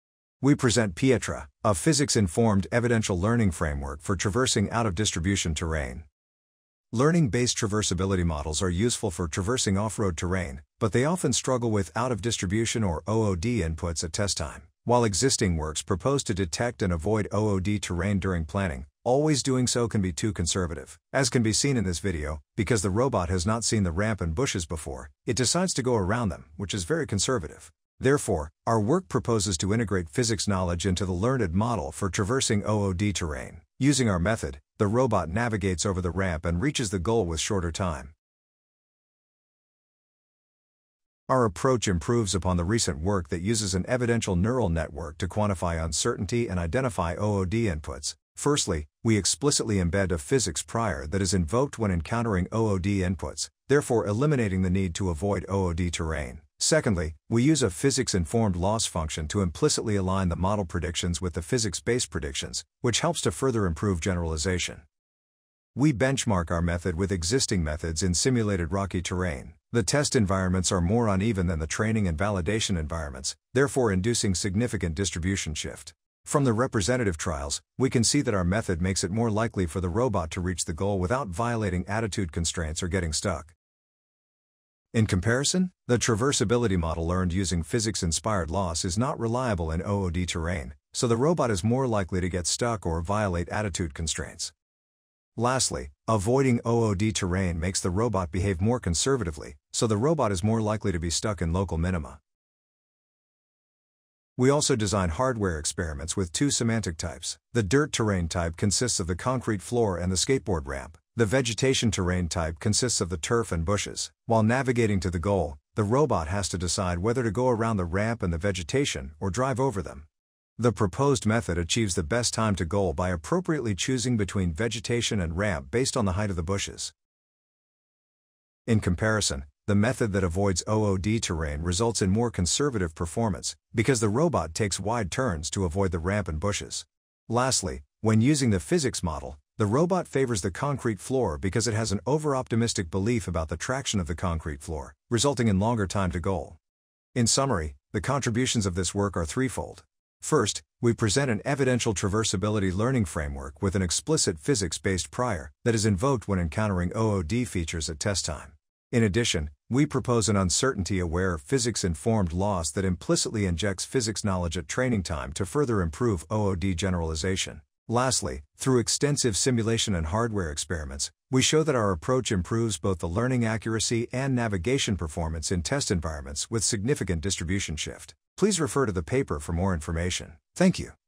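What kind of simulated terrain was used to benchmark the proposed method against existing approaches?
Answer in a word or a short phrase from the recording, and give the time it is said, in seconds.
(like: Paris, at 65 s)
rocky terrain, at 68 s.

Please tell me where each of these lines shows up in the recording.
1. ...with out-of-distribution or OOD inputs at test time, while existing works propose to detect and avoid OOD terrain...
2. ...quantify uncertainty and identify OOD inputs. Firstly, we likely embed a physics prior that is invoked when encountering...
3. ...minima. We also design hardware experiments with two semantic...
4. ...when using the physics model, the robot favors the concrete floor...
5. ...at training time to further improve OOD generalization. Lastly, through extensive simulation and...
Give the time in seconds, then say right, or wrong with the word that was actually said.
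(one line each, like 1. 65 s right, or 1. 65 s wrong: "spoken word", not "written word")
1. 11 s right
2. 45 s wrong: "explicitly", not "likely"
3. 101 s right
4. 137 s right
5. 164 s right.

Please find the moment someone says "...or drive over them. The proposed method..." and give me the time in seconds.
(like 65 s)
119 s.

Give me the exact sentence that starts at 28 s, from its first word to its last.
Therefore, our work proposes to integrate physics knowledge into the learned model for traversing OOD terrain.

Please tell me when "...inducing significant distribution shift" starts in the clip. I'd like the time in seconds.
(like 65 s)
73 s.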